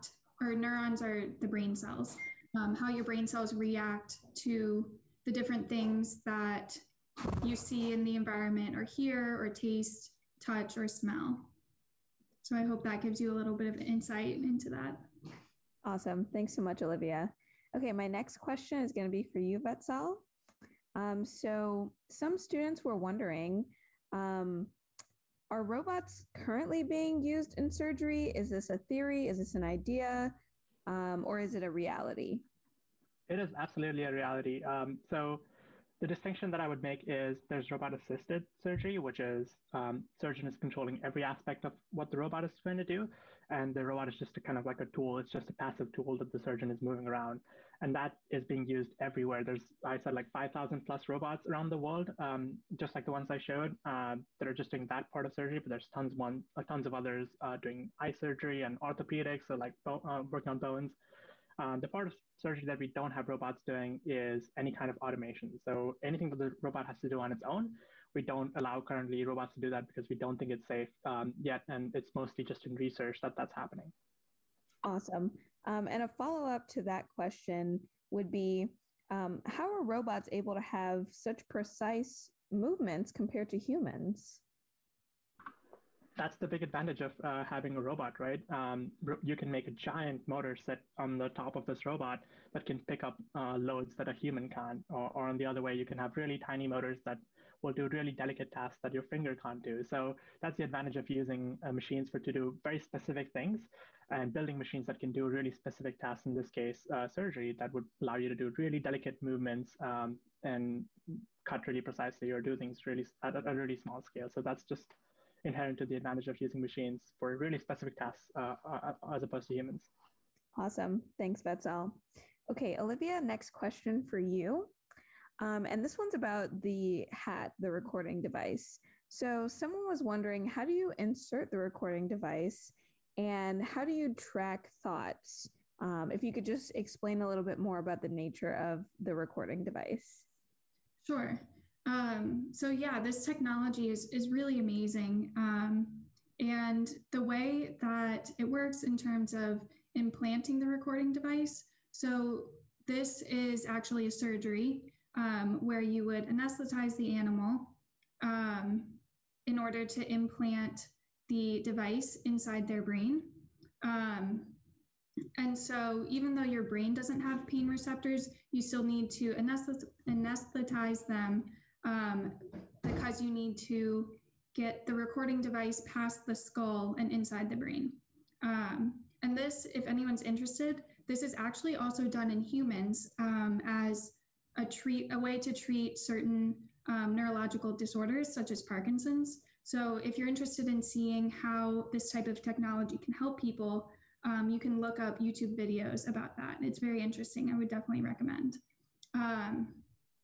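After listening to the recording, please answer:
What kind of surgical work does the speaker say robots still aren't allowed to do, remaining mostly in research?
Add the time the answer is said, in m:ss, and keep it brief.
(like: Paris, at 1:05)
Automation, at 1:04.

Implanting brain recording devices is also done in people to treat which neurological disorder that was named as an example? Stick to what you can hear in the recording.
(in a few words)
Parkinson's.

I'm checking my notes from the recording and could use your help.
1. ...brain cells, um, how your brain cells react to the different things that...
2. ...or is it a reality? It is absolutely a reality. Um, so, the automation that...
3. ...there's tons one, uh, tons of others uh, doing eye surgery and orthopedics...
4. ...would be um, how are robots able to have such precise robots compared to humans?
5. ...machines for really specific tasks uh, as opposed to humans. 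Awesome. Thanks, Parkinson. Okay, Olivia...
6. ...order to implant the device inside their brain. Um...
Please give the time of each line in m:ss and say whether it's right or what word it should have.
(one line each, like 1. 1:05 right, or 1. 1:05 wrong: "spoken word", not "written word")
1. 0:01 right
2. 0:31 wrong: "distinction", not "automation"
3. 0:55 right
4. 1:18 wrong: "movements", not "robots"
5. 1:56 wrong: "Vatsal", not "Parkinson"
6. 2:39 right.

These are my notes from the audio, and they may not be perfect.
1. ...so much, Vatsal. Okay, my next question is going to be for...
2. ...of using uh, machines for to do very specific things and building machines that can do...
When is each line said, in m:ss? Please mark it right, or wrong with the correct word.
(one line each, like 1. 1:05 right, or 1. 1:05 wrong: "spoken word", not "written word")
1. 0:16 wrong: "Olivia", not "Vatsal"
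2. 1:40 right.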